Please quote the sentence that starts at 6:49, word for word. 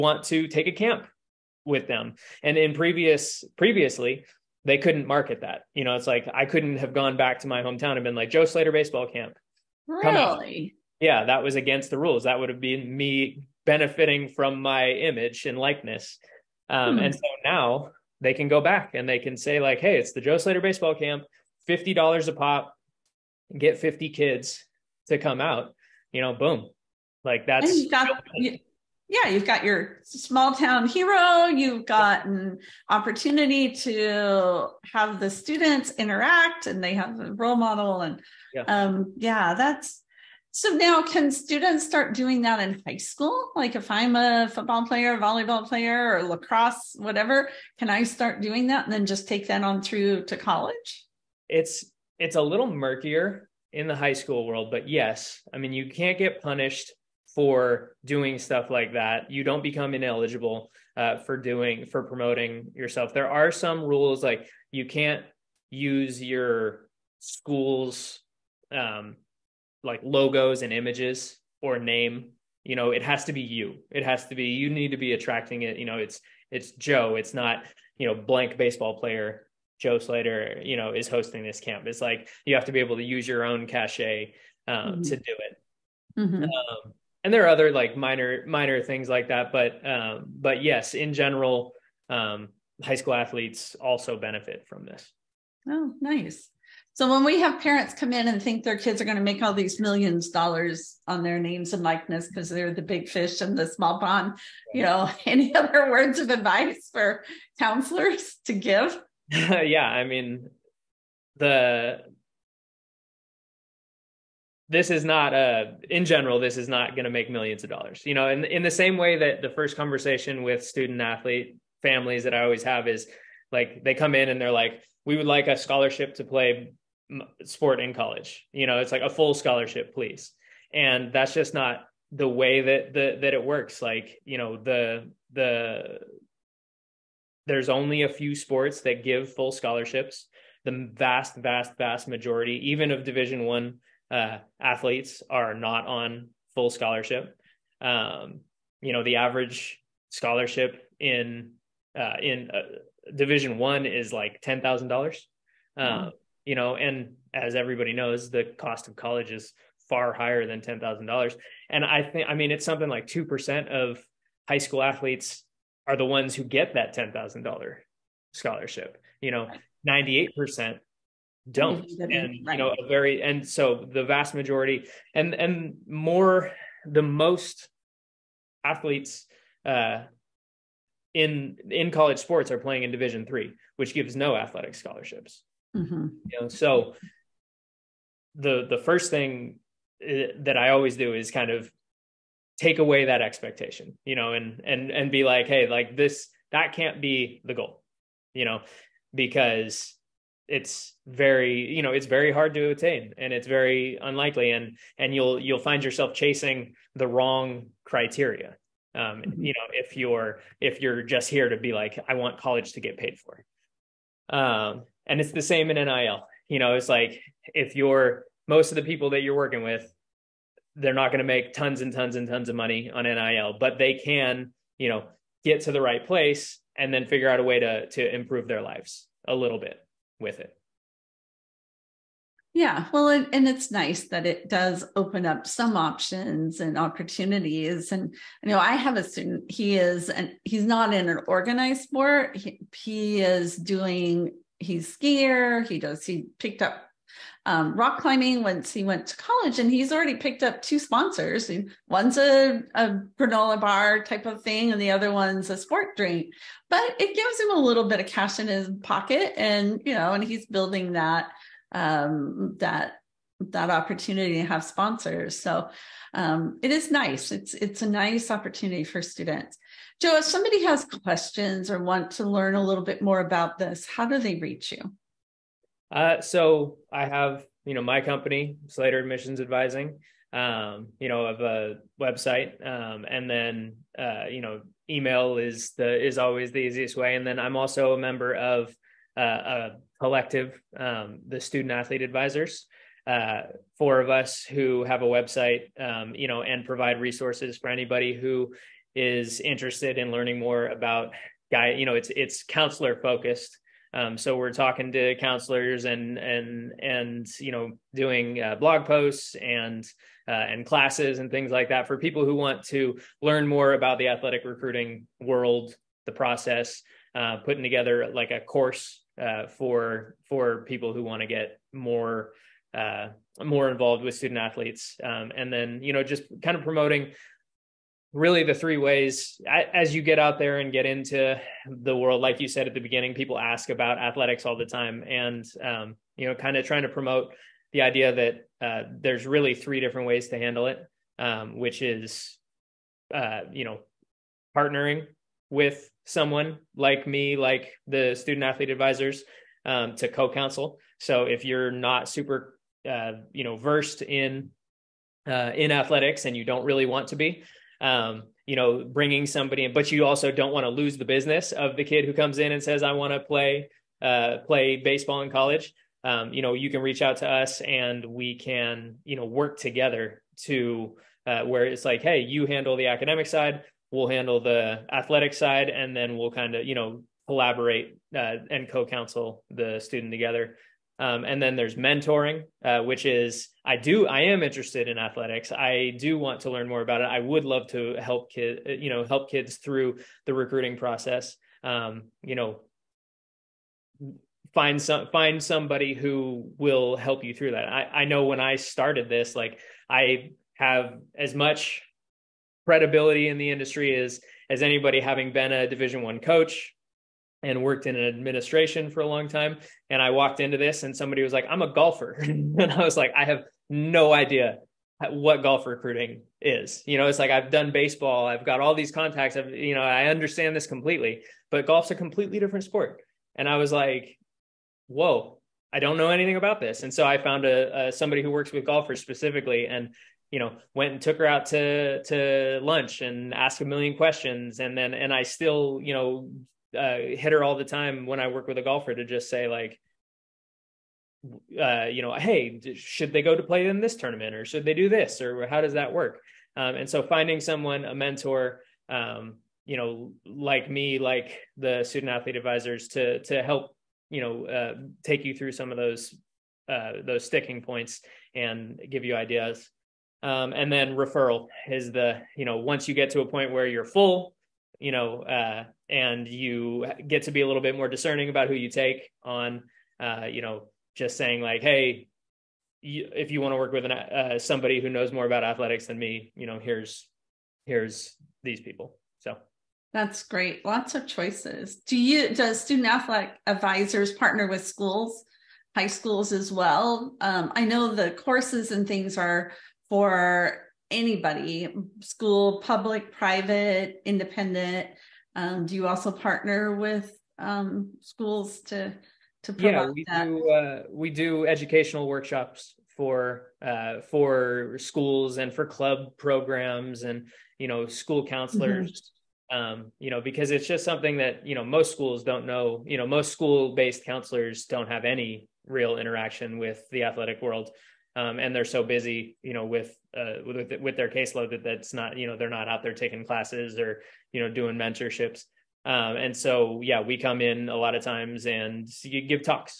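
And I walked into this and somebody was like, I'm a golfer.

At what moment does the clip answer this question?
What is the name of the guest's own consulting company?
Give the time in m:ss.
4:38.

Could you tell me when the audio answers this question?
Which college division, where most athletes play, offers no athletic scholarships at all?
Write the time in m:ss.
3:02.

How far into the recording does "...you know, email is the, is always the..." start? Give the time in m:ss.
4:44.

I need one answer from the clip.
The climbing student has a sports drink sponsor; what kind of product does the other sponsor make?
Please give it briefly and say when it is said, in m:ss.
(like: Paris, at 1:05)
Granola bar, at 4:13.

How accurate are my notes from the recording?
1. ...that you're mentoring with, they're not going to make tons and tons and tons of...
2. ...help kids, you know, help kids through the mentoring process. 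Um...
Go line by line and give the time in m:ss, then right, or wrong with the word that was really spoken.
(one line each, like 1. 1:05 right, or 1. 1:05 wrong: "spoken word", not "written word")
1. 3:39 wrong: "working", not "mentoring"
2. 6:28 wrong: "recruiting", not "mentoring".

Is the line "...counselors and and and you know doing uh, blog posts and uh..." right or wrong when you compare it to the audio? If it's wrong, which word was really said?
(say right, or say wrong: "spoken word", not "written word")
right.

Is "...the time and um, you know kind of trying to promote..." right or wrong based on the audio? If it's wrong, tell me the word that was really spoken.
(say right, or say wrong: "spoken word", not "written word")
right.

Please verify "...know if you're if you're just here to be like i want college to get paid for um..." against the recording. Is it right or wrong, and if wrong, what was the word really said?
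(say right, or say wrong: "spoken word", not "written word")
right.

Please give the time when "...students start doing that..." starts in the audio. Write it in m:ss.
0:41.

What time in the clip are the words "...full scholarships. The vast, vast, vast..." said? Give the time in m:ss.
2:19.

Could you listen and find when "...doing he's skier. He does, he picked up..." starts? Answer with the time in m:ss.
4:03.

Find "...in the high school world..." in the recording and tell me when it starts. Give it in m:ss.
0:53.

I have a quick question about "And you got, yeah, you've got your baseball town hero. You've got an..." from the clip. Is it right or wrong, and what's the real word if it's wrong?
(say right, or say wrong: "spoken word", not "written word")
wrong: "small", not "baseball".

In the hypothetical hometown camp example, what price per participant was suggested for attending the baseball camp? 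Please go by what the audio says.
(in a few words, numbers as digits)
$50.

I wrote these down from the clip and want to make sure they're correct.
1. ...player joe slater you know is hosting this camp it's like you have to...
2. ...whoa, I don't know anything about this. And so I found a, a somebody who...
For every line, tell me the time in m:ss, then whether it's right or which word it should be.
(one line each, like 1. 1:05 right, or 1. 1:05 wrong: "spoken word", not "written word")
1. 1:18 right
2. 7:04 right.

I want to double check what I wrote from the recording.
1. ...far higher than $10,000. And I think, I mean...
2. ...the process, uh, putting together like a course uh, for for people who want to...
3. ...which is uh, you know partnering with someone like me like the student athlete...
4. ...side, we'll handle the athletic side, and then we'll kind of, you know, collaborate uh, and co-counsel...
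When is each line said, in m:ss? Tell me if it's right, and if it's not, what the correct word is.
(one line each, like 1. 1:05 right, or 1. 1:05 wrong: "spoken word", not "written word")
1. 2:39 right
2. 5:16 right
3. 5:41 right
4. 6:13 right.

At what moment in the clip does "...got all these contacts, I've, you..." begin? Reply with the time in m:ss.
6:58.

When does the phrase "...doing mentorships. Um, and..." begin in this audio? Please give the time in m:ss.
8:44.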